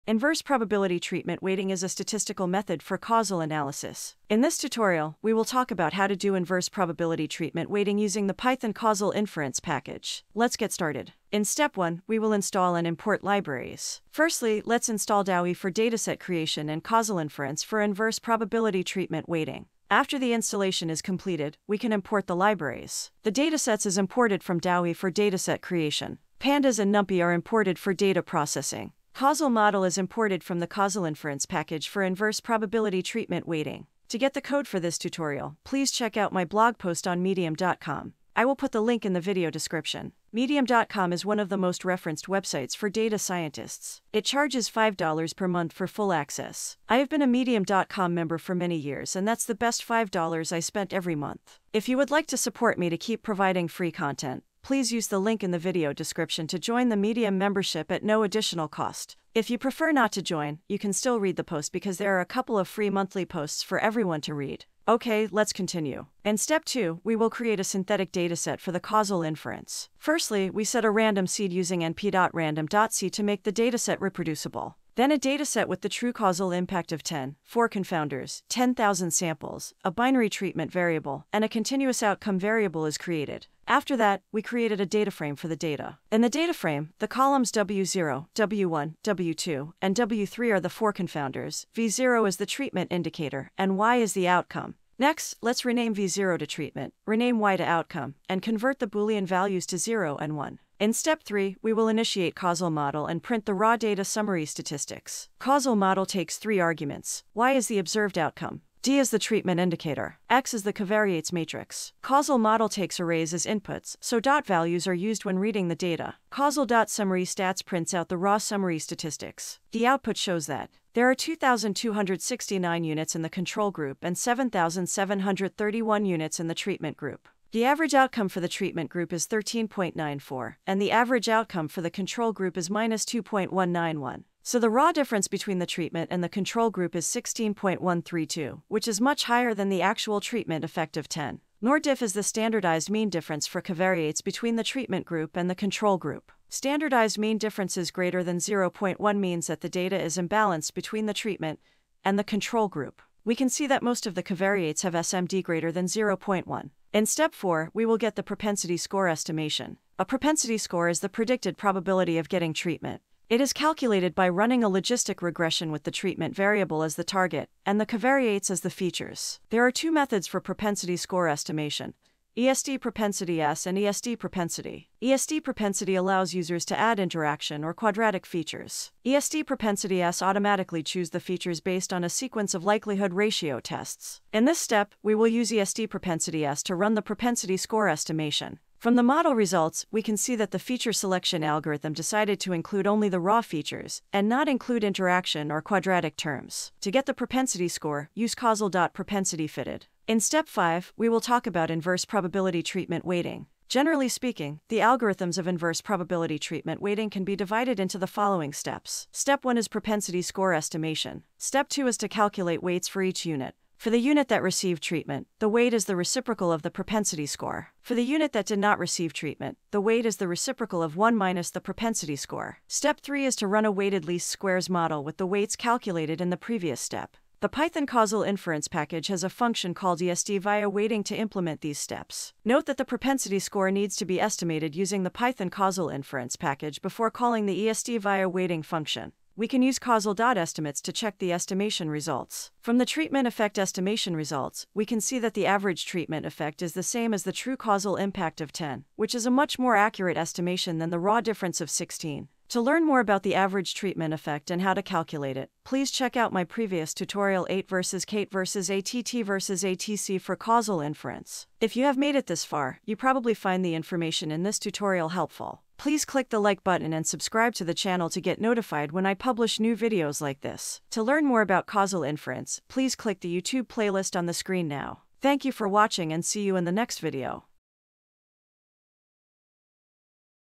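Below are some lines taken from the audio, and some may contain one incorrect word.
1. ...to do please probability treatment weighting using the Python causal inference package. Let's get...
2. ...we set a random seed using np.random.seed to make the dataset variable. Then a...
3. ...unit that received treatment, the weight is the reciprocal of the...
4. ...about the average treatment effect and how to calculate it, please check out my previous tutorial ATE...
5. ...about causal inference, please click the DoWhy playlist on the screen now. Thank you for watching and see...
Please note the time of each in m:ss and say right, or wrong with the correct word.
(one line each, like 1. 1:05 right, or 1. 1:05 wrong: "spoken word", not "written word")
1. 0:06 wrong: "inverse", not "please"
2. 1:10 wrong: "reproducible", not "variable"
3. 3:33 right
4. 4:12 right
5. 4:31 wrong: "YouTube", not "DoWhy".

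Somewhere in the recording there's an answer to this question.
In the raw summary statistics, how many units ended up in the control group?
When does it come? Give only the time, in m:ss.
2:01.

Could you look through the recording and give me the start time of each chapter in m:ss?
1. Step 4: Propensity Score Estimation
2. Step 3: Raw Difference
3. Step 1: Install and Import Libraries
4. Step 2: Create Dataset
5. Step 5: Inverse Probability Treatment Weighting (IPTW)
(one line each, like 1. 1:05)
1. 2:36
2. 1:40
3. 0:11
4. 1:06
5. 3:19.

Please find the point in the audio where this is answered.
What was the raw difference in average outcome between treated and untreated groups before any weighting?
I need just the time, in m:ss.
2:17.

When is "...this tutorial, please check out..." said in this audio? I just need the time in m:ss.
0:34.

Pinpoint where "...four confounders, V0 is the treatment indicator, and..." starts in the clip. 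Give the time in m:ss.
1:30.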